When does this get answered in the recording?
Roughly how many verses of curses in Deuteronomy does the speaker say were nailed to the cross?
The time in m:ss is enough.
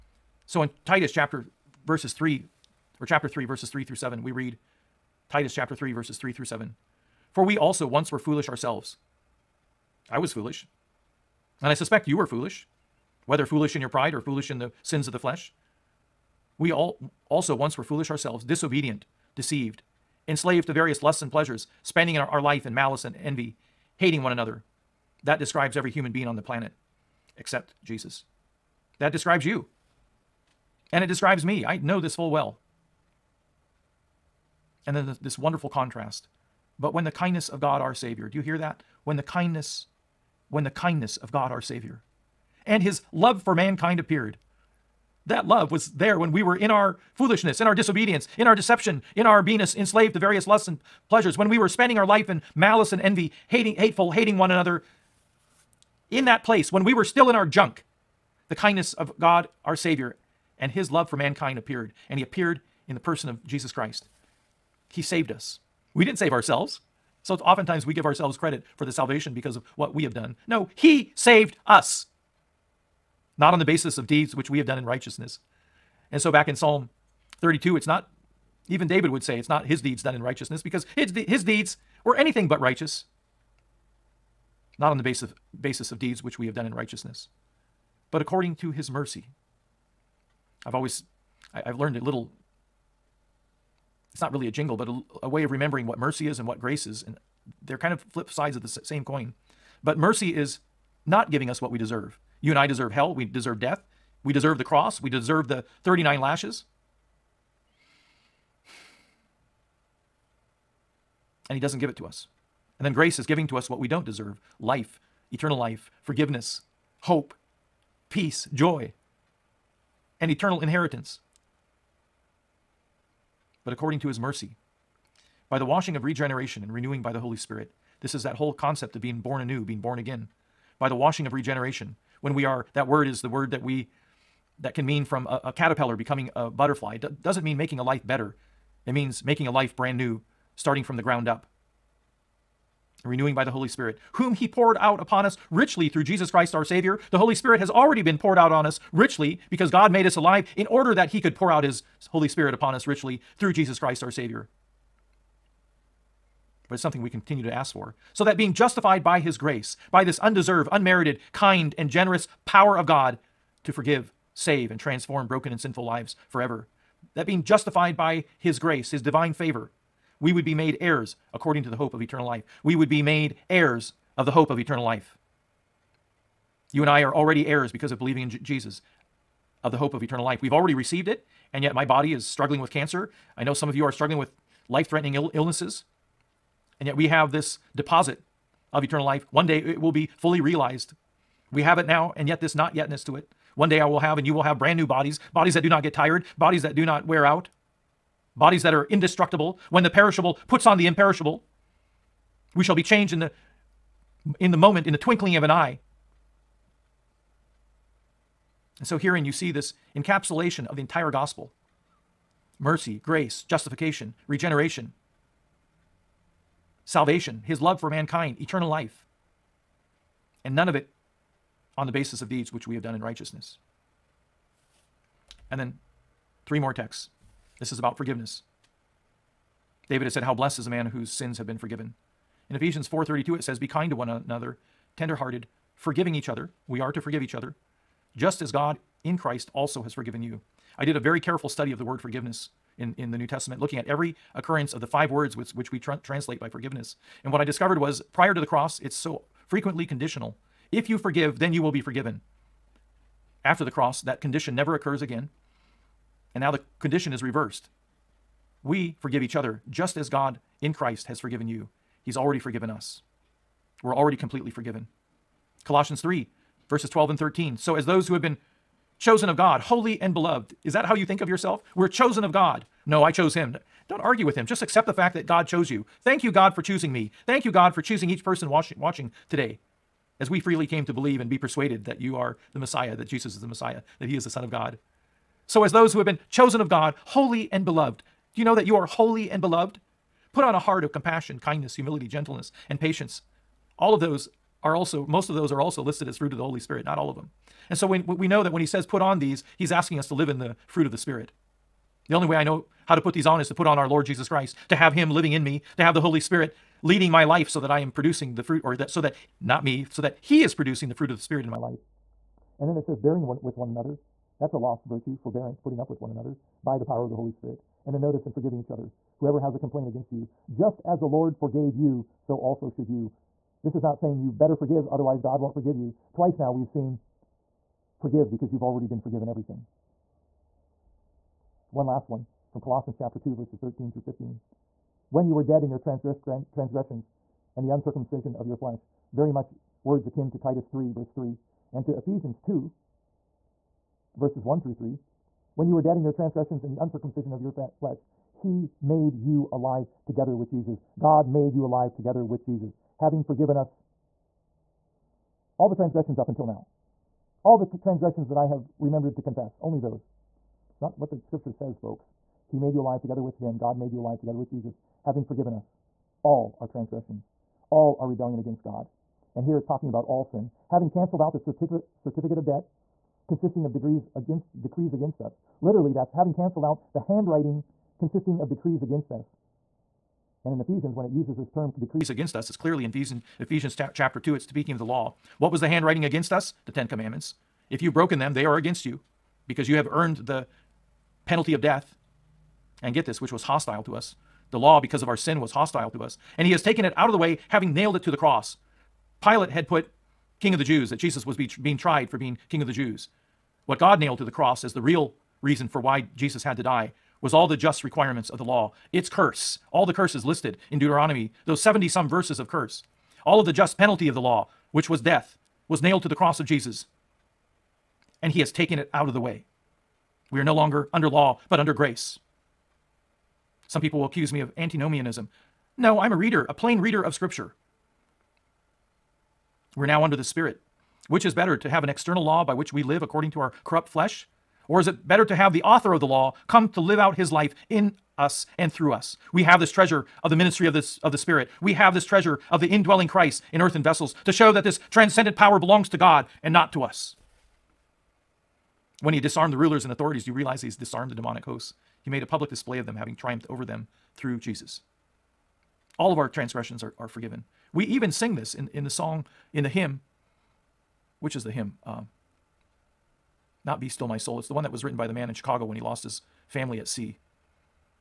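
6:51.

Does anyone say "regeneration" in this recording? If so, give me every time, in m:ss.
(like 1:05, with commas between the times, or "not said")
2:06, 2:11, 3:34.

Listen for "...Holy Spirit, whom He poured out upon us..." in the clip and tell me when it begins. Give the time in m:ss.
2:23.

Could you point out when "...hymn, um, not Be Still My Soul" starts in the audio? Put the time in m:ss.
7:41.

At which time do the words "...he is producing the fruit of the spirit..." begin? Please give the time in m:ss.
5:10.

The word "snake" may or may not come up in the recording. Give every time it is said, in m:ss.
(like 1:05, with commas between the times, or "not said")
not said.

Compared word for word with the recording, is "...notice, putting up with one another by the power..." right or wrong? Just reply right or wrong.
wrong.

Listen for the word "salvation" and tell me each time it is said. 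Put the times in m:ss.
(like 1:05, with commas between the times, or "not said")
1:08, 3:36.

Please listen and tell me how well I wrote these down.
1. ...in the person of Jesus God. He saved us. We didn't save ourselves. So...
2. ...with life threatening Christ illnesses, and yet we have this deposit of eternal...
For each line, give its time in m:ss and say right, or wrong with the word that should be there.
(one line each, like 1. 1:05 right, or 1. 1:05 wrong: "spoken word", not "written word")
1. 1:02 wrong: "Christ", not "God"
2. 3:04 wrong: "Ill", not "Christ".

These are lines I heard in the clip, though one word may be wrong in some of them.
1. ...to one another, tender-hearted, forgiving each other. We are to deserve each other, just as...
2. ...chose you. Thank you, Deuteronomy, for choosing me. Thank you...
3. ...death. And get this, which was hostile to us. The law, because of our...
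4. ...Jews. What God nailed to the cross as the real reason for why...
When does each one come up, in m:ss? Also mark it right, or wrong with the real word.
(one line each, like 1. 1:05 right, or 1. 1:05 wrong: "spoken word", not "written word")
1. 3:53 wrong: "forgive", not "deserve"
2. 4:35 wrong: "God", not "Deuteronomy"
3. 6:31 right
4. 6:42 right.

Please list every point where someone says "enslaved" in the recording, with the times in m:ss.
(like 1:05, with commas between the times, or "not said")
0:20, 0:49.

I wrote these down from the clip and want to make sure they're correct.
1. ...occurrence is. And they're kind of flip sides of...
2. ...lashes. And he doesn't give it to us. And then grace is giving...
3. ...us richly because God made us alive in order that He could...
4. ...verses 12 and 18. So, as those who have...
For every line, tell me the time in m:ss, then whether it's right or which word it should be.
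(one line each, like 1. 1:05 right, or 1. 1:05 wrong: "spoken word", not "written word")
1. 1:36 wrong: "grace", not "occurrence"
2. 1:46 right
3. 2:28 right
4. 4:26 wrong: "13", not "18".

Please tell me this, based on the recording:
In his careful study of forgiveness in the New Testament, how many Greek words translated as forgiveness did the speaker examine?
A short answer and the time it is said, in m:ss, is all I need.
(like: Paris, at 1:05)
5, at 4:04.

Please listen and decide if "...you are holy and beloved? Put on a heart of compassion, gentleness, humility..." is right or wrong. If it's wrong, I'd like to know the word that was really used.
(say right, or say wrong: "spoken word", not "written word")
wrong: "kindness", not "gentleness".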